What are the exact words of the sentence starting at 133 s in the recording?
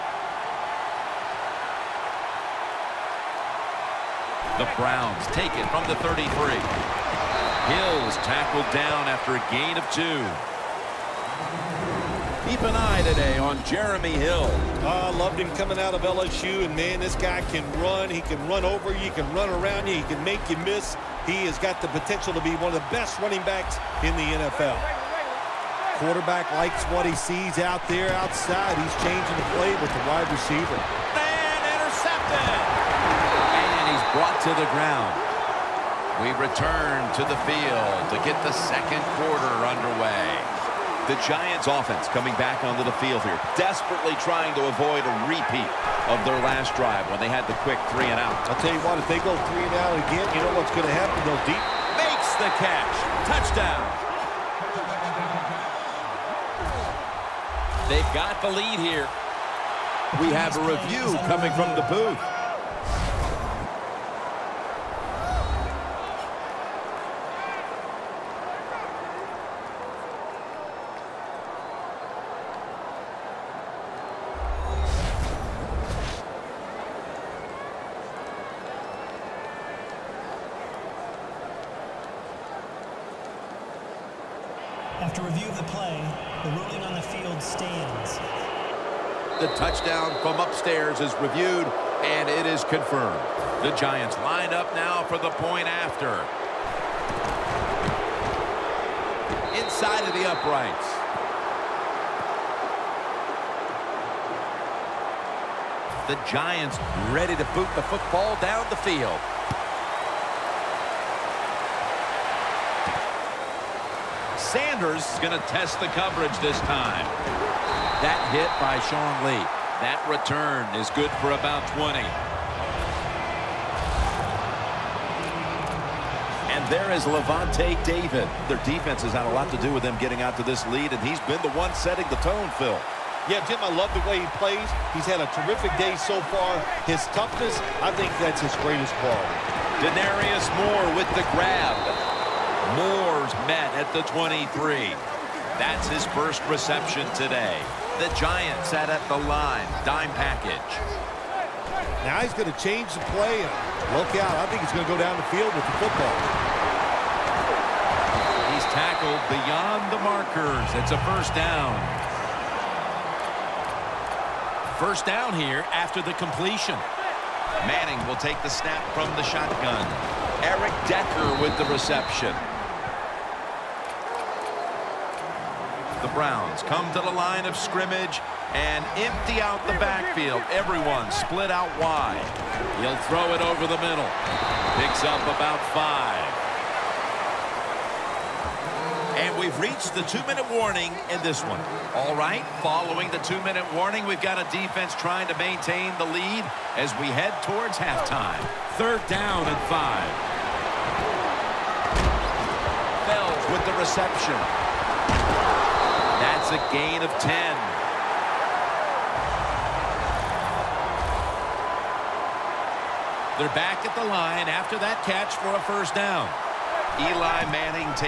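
Yeah, Jim, I love the way he plays.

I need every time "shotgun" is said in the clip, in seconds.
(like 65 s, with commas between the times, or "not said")
169 s.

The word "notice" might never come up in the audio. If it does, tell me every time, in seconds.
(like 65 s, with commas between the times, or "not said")
not said.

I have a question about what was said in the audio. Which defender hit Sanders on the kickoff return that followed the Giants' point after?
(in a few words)
Sean Lee.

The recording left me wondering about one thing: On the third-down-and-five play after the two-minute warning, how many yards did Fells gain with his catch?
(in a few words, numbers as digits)
10.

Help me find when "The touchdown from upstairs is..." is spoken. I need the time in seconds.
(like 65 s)
89 s.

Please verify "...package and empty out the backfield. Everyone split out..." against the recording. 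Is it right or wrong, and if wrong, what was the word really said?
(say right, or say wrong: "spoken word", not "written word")
wrong: "scrimmage", not "package".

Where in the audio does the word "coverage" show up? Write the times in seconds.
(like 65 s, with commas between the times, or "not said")
115 s.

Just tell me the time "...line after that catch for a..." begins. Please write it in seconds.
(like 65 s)
214 s.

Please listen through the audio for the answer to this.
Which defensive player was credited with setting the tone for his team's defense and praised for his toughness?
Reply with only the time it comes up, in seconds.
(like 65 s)
127 s.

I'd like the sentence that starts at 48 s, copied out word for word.
I'll tell you what, if they go three and out again, you know what's going to happen.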